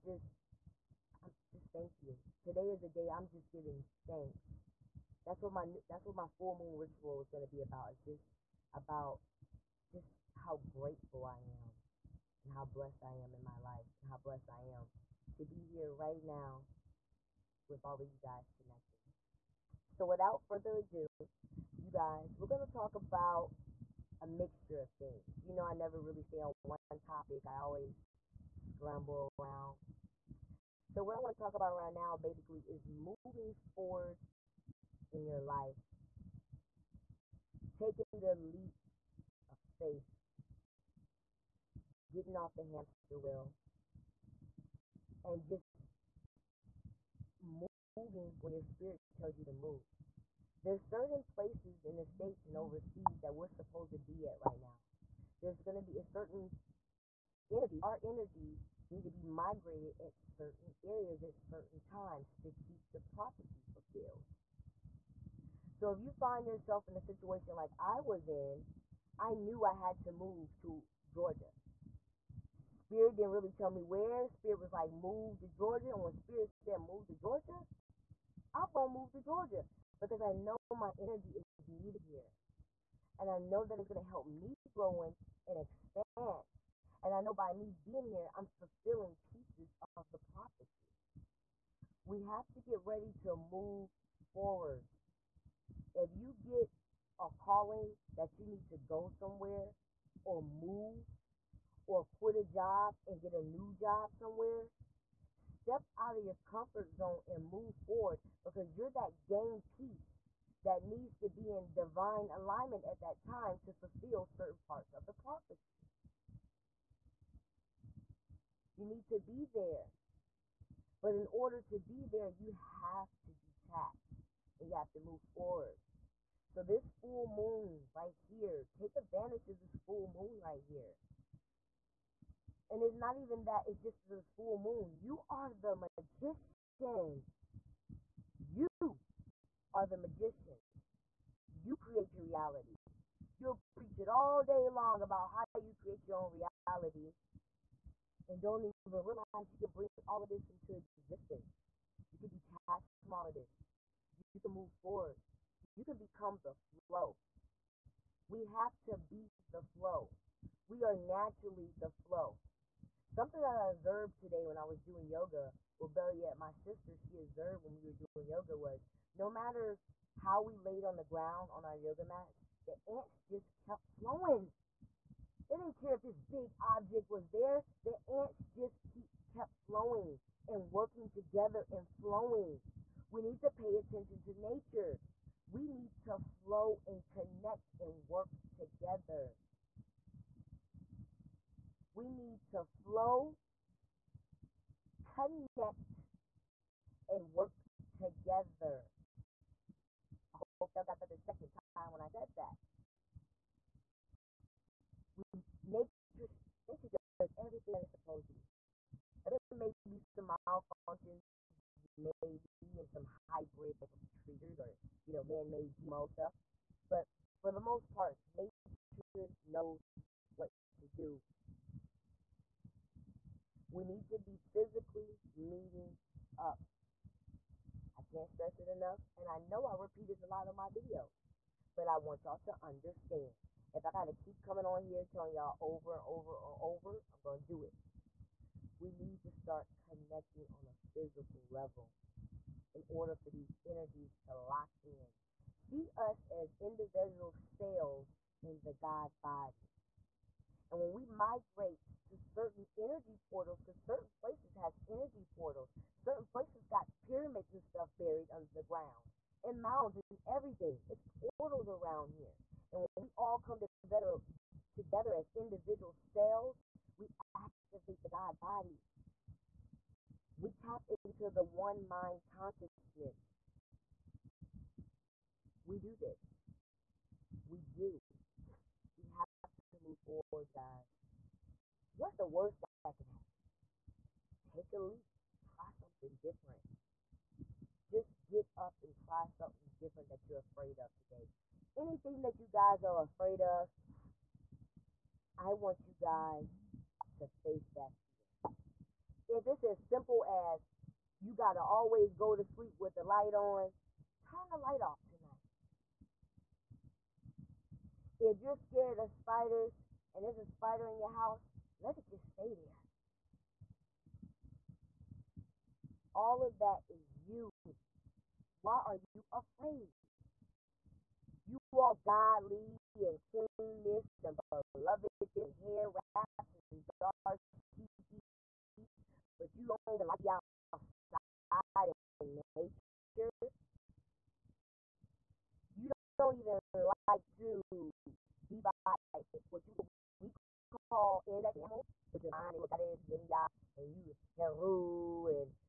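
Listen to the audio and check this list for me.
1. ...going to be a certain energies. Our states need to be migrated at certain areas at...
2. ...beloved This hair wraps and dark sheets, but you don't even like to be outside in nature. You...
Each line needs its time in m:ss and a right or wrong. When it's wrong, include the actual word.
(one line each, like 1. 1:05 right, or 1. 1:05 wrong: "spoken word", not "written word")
1. 0:55 wrong: "energies", not "states"
2. 5:24 right.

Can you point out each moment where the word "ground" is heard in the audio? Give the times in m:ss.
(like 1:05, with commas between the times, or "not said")
2:51, 4:18.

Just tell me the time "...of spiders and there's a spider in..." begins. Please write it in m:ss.
5:09.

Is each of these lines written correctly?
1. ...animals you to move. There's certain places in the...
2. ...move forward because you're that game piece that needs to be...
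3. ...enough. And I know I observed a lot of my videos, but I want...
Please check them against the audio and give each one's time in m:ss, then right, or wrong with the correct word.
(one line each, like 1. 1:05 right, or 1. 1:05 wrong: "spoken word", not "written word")
1. 0:49 wrong: "tells", not "animals"
2. 1:47 right
3. 3:48 wrong: "repeated", not "observed".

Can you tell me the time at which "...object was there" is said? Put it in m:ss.
2:56.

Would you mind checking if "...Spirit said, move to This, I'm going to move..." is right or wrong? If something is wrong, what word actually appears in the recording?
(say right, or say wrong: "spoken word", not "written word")
wrong: "Georgia", not "This".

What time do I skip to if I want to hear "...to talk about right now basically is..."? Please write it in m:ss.
0:31.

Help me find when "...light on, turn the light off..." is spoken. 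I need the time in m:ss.
5:03.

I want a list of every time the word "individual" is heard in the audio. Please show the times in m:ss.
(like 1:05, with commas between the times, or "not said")
4:06, 4:25.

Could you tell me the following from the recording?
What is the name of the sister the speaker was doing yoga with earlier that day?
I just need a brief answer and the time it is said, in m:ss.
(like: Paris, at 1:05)
Belliette, at 2:45.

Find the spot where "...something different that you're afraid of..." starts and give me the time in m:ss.
4:49.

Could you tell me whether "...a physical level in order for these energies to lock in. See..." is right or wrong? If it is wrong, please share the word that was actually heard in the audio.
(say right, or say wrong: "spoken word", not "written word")
right.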